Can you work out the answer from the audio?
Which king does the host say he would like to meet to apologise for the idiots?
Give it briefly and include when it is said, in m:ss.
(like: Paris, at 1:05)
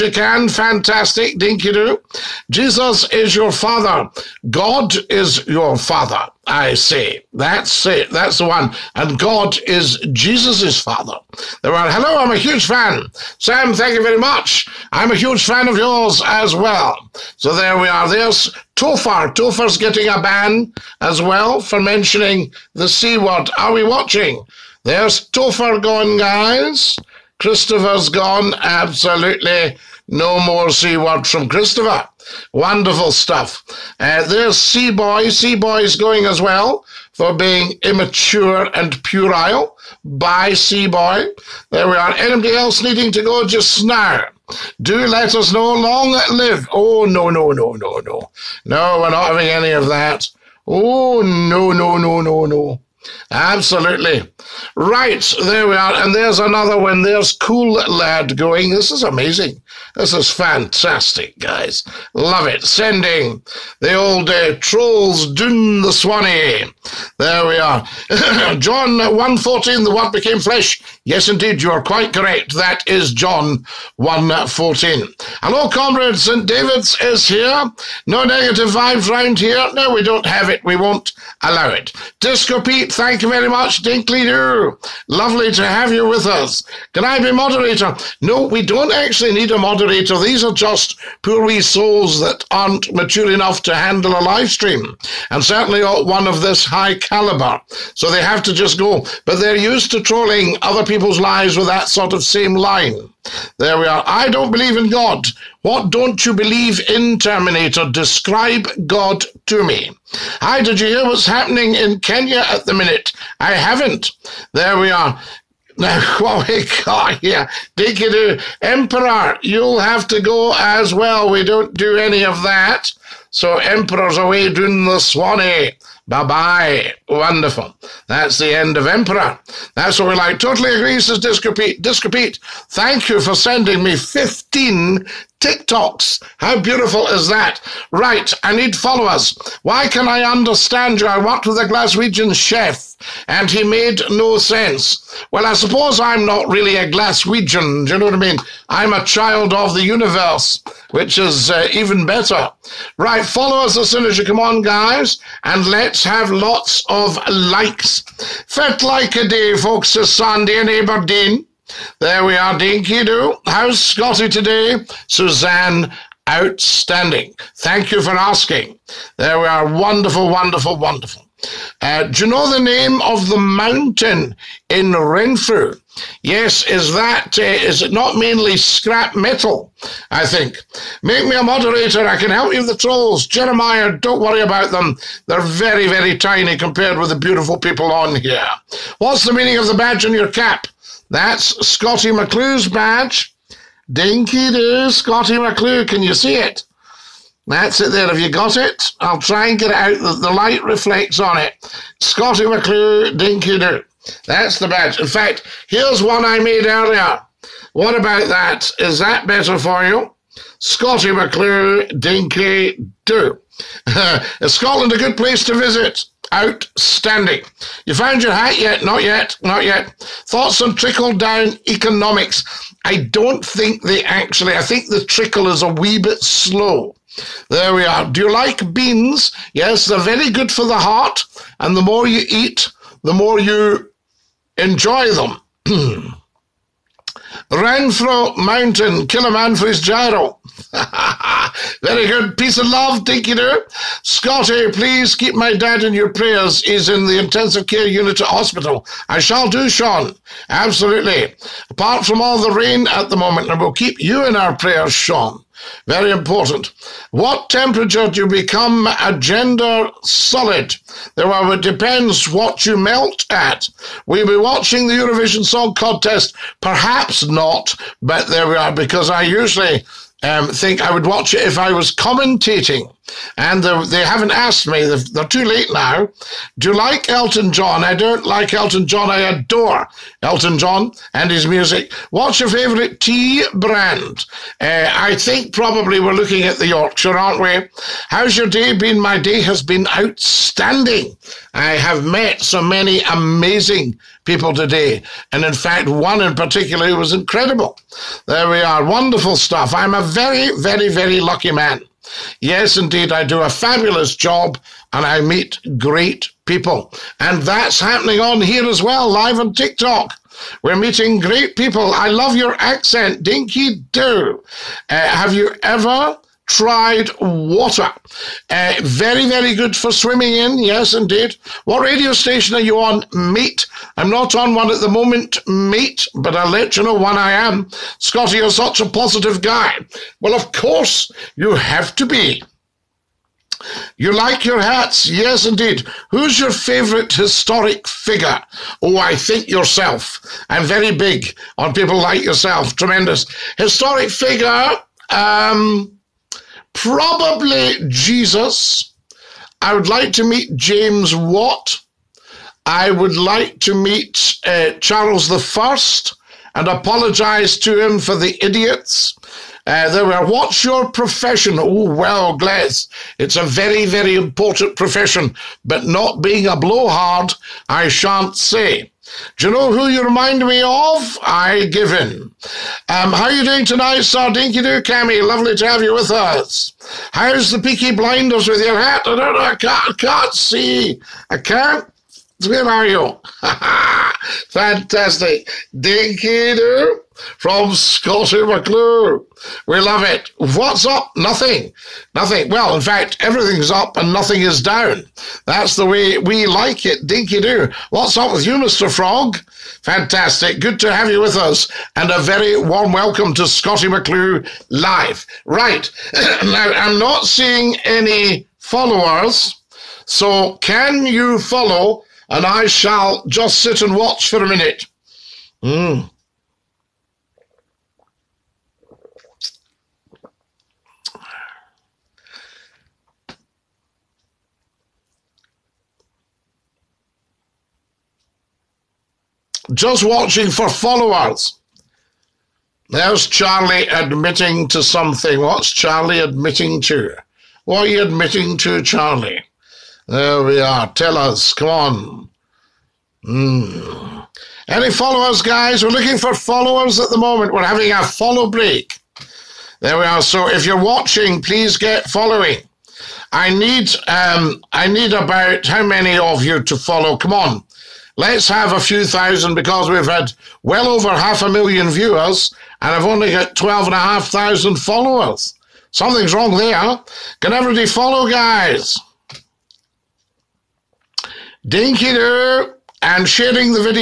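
Charles the First, at 5:54.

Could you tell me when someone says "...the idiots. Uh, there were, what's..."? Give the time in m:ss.
5:58.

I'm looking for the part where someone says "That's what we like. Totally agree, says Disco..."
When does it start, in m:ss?
2:09.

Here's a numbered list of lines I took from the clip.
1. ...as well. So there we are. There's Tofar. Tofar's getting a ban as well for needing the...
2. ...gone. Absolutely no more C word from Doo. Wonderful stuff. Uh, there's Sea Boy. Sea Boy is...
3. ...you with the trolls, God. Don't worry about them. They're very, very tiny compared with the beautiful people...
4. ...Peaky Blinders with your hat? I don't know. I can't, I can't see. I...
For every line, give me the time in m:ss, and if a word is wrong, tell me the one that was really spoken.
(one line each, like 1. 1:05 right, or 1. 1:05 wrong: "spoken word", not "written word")
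1. 0:16 wrong: "mentioning", not "needing"
2. 0:28 wrong: "Christopher", not "Doo"
3. 3:02 wrong: "Jeremiah", not "God"
4. 6:17 right.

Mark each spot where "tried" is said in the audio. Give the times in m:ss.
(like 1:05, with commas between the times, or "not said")
5:16.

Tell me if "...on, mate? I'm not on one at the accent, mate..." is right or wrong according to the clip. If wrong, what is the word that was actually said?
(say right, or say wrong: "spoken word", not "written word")
wrong: "moment", not "accent".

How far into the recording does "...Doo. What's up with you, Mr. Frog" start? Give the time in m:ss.
6:37.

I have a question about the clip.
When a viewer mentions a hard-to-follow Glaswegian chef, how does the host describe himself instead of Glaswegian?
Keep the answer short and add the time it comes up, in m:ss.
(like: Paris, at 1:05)
A child of the universe, at 2:29.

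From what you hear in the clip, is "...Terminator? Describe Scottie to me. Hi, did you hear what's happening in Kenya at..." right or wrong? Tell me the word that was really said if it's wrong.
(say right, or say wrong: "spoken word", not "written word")
wrong: "God", not "Scottie".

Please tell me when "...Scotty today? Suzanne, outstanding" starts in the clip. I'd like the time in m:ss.
2:43.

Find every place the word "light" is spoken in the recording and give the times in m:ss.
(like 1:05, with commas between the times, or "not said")
3:20.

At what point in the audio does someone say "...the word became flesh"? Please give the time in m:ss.
1:09.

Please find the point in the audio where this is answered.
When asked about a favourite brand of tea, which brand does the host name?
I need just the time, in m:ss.
4:46.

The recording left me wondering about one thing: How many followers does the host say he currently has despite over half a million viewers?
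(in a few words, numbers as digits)
12,500.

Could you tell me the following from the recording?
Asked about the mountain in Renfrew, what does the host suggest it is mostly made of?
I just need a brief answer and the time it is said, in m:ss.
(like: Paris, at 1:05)
Scrap metal, at 2:58.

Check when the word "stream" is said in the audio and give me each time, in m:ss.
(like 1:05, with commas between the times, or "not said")
1:34.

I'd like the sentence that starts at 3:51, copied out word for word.
And the more you eat, the more you enjoy them.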